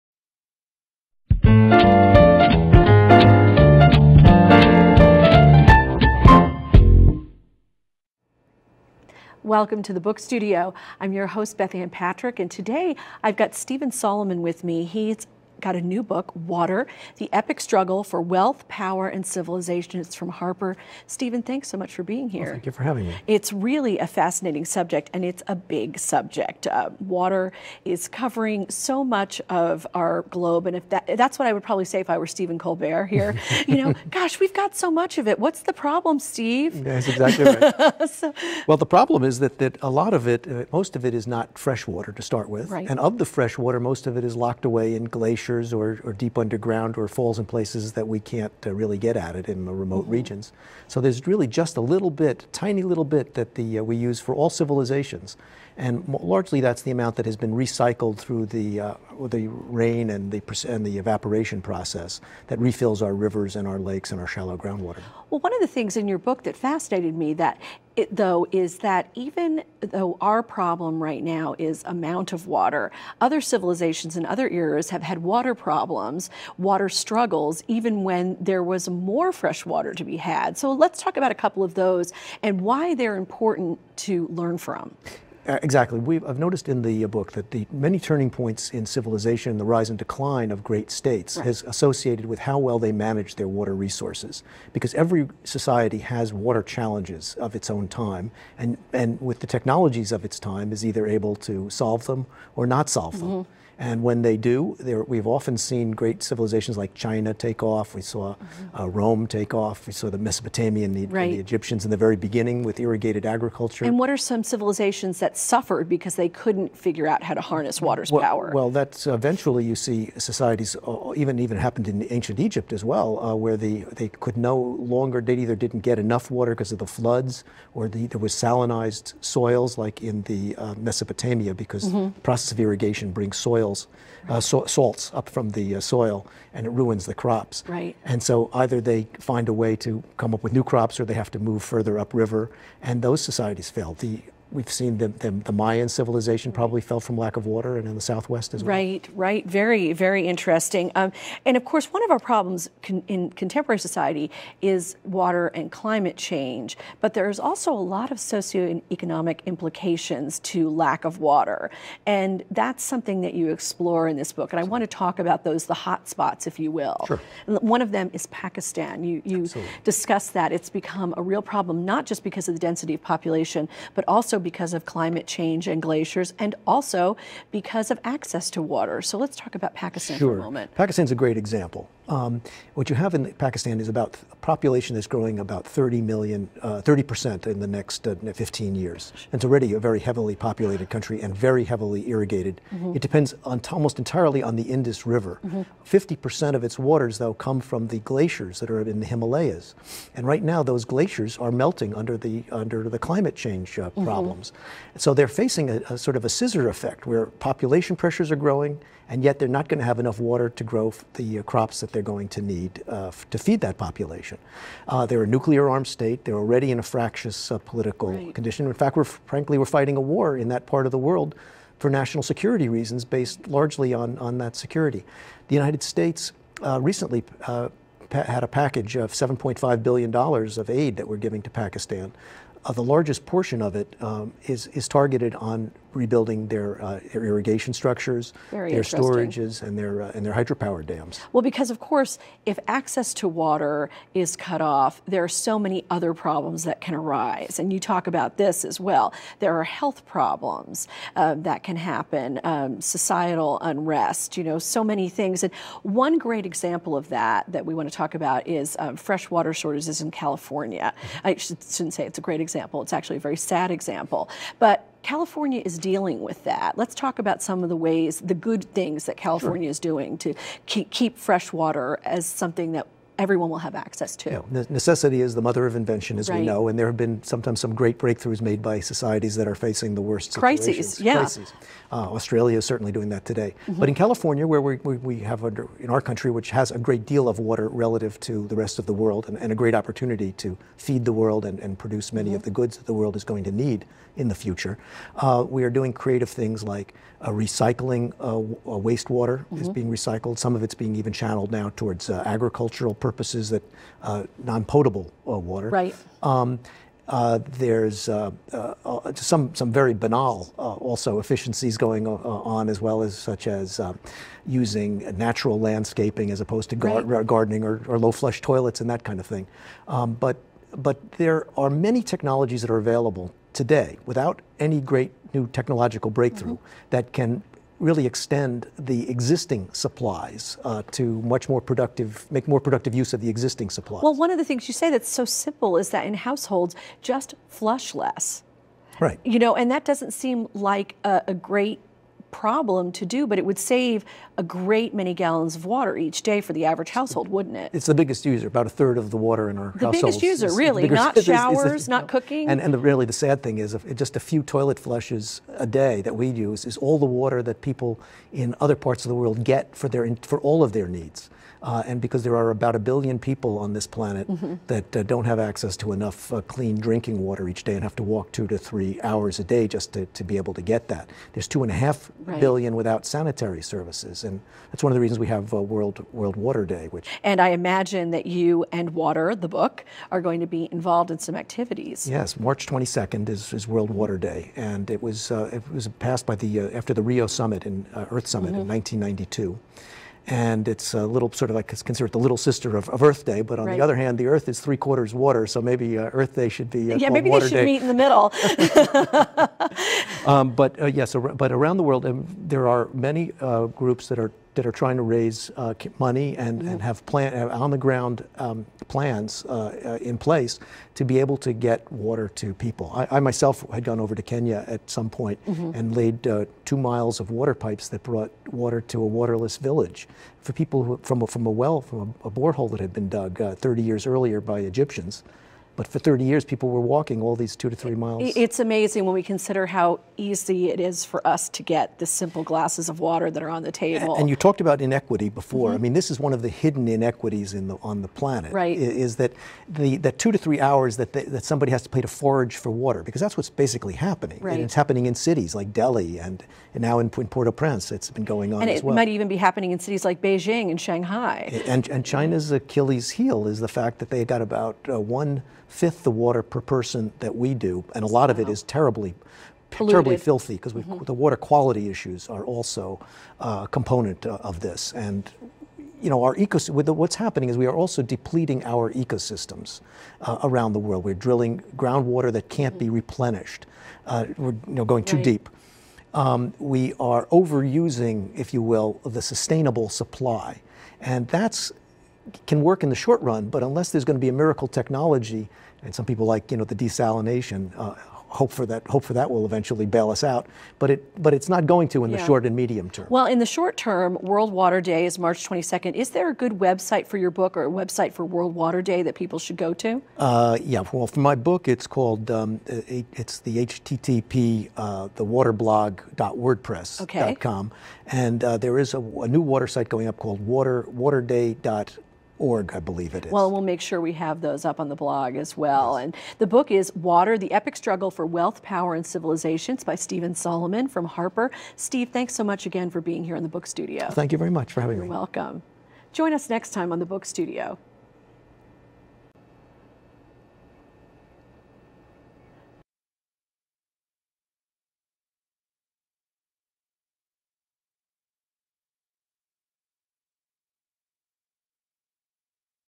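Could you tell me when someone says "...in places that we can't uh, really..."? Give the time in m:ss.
0:47.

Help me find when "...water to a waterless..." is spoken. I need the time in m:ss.
6:58.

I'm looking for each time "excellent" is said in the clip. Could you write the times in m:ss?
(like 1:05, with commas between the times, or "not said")
not said.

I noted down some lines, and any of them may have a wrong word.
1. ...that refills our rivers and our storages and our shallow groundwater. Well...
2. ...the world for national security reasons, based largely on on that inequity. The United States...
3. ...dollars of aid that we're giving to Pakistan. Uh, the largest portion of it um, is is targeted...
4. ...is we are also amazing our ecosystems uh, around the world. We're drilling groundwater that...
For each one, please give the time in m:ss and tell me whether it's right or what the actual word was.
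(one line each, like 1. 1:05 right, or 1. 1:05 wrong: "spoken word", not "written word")
1. 1:02 wrong: "lakes", not "storages"
2. 3:40 wrong: "security", not "inequity"
3. 3:50 right
4. 7:47 wrong: "depleting", not "amazing".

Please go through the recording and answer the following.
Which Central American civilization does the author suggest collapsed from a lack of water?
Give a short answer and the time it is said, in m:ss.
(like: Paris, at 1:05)
Mayan, at 2:25.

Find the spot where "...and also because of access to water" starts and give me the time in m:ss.
2:56.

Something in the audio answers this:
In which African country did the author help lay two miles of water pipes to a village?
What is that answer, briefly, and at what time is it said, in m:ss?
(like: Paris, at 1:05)
Kenya, at 6:54.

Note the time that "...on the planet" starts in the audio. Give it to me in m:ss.
7:17.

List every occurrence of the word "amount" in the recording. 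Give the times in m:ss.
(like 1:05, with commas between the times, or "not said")
0:56, 1:11.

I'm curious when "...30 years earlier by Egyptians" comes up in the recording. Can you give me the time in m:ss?
7:03.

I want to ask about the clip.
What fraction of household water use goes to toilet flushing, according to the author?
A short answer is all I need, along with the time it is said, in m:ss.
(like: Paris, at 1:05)
a third, at 5:48.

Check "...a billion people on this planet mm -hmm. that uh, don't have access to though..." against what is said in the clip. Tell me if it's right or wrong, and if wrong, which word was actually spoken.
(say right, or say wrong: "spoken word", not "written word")
wrong: "enough", not "though".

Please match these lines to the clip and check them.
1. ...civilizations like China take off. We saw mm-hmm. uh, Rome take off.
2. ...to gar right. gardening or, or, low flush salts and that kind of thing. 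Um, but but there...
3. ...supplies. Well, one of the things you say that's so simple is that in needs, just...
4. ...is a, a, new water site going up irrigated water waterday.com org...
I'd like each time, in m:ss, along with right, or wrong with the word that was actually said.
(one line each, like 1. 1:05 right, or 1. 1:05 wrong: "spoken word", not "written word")
1. 1:46 right
2. 5:16 wrong: "toilets", not "salts"
3. 5:33 wrong: "households", not "needs"
4. 8:28 wrong: "called", not "irrigated".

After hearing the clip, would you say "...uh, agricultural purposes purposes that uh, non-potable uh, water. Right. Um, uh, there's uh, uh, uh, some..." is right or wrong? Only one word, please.
right.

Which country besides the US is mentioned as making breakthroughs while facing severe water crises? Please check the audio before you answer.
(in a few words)
Australia.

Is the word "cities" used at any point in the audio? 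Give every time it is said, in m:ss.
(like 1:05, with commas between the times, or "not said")
7:25, 7:29.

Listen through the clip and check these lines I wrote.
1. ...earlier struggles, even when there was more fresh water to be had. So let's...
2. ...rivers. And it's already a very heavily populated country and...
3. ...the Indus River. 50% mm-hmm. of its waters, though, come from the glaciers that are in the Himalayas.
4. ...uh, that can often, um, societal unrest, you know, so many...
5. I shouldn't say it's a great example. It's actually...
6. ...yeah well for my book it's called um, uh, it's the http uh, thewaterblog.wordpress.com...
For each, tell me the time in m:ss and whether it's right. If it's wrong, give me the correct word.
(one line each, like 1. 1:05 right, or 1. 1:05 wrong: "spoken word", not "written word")
1. 1:16 wrong: "water", not "earlier"
2. 3:08 wrong: "years", not "rivers"
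3. 3:14 right
4. 4:11 wrong: "happen", not "often"
5. 4:21 right
6. 8:20 right.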